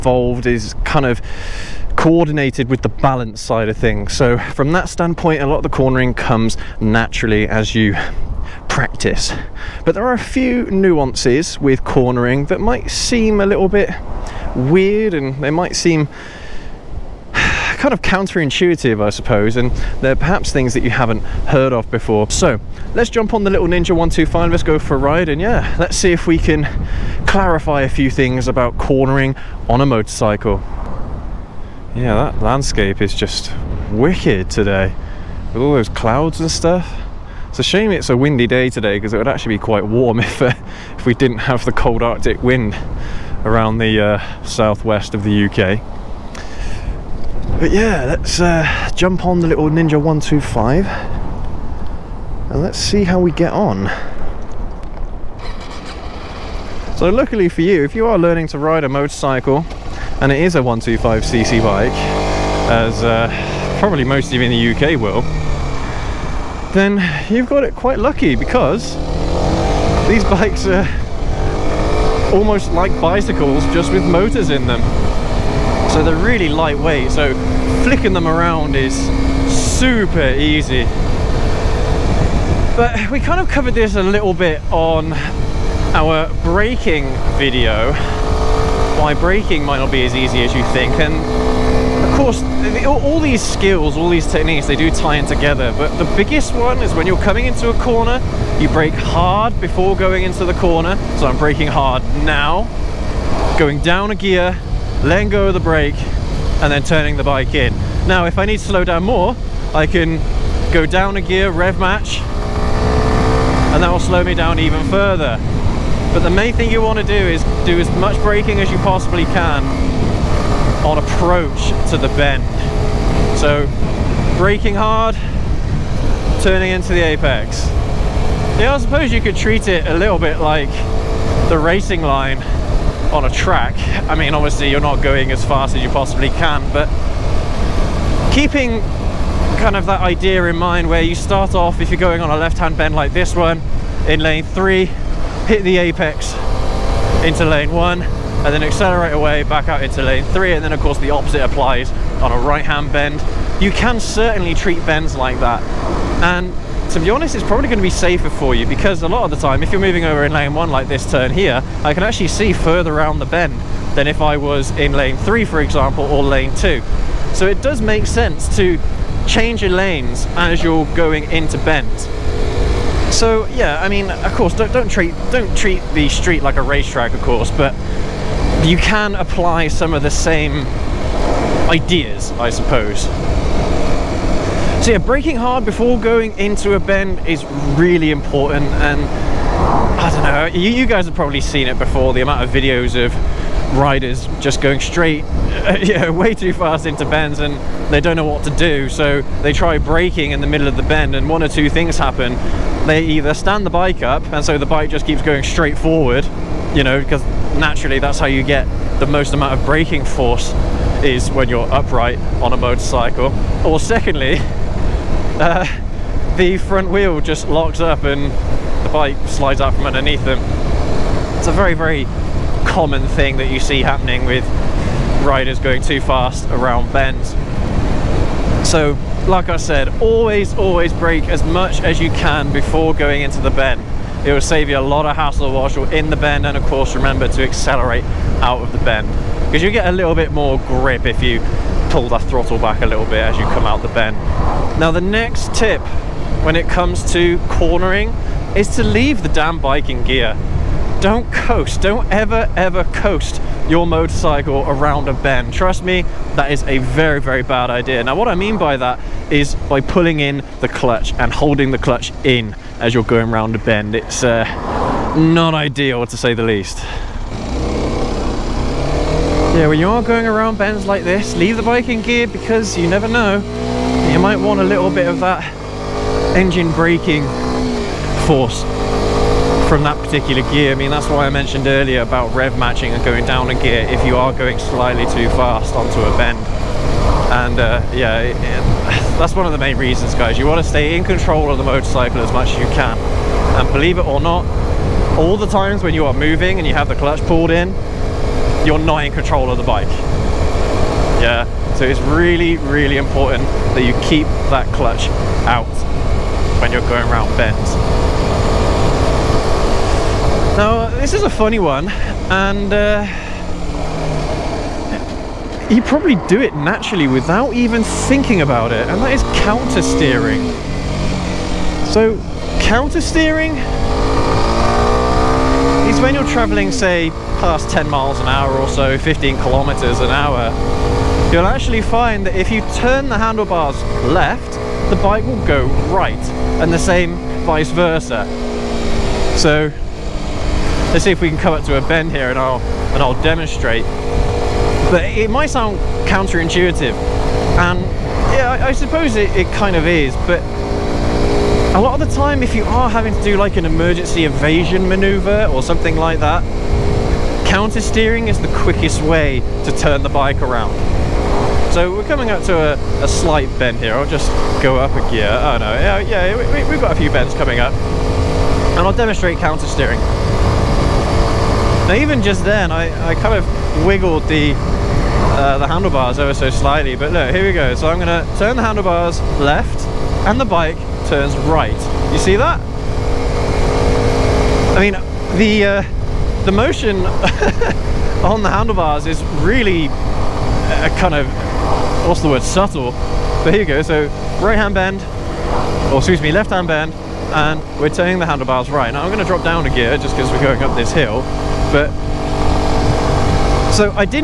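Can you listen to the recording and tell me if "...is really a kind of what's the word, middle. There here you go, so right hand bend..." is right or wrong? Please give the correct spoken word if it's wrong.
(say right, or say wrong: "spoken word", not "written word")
wrong: "subtle", not "middle".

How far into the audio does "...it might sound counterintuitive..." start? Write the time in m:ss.
5:45.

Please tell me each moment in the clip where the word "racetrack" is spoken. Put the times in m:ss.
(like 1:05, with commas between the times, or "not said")
2:56.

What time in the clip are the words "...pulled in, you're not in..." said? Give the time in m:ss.
4:57.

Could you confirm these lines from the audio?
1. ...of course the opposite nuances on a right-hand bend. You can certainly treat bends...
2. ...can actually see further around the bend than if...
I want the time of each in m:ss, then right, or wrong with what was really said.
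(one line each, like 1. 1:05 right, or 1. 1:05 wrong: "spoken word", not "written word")
1. 2:30 wrong: "applies", not "nuances"
2. 2:41 right.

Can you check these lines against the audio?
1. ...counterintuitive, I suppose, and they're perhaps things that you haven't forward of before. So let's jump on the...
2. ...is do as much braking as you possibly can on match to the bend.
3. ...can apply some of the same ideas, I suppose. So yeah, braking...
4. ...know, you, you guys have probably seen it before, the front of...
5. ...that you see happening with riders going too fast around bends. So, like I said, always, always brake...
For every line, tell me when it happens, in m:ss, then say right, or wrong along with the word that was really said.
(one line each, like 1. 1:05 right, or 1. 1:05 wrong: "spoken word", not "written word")
1. 0:18 wrong: "heard", not "forward"
2. 1:57 wrong: "approach", not "match"
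3. 2:58 right
4. 3:10 wrong: "amount", not "front"
5. 3:43 right.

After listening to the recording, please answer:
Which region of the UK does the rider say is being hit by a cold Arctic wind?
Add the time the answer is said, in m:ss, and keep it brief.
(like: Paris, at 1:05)
southwest, at 0:44.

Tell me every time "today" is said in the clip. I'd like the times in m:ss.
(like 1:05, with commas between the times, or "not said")
0:34, 0:38.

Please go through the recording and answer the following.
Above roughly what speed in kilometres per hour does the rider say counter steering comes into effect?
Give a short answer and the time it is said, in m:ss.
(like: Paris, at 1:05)
15 kilometres per hour, at 5:28.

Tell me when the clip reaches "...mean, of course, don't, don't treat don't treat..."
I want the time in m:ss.
2:53.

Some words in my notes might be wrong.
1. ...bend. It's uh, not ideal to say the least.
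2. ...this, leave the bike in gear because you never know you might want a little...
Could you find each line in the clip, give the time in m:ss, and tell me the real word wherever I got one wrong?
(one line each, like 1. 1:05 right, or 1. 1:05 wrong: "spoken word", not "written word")
1. 4:23 right
2. 4:31 right.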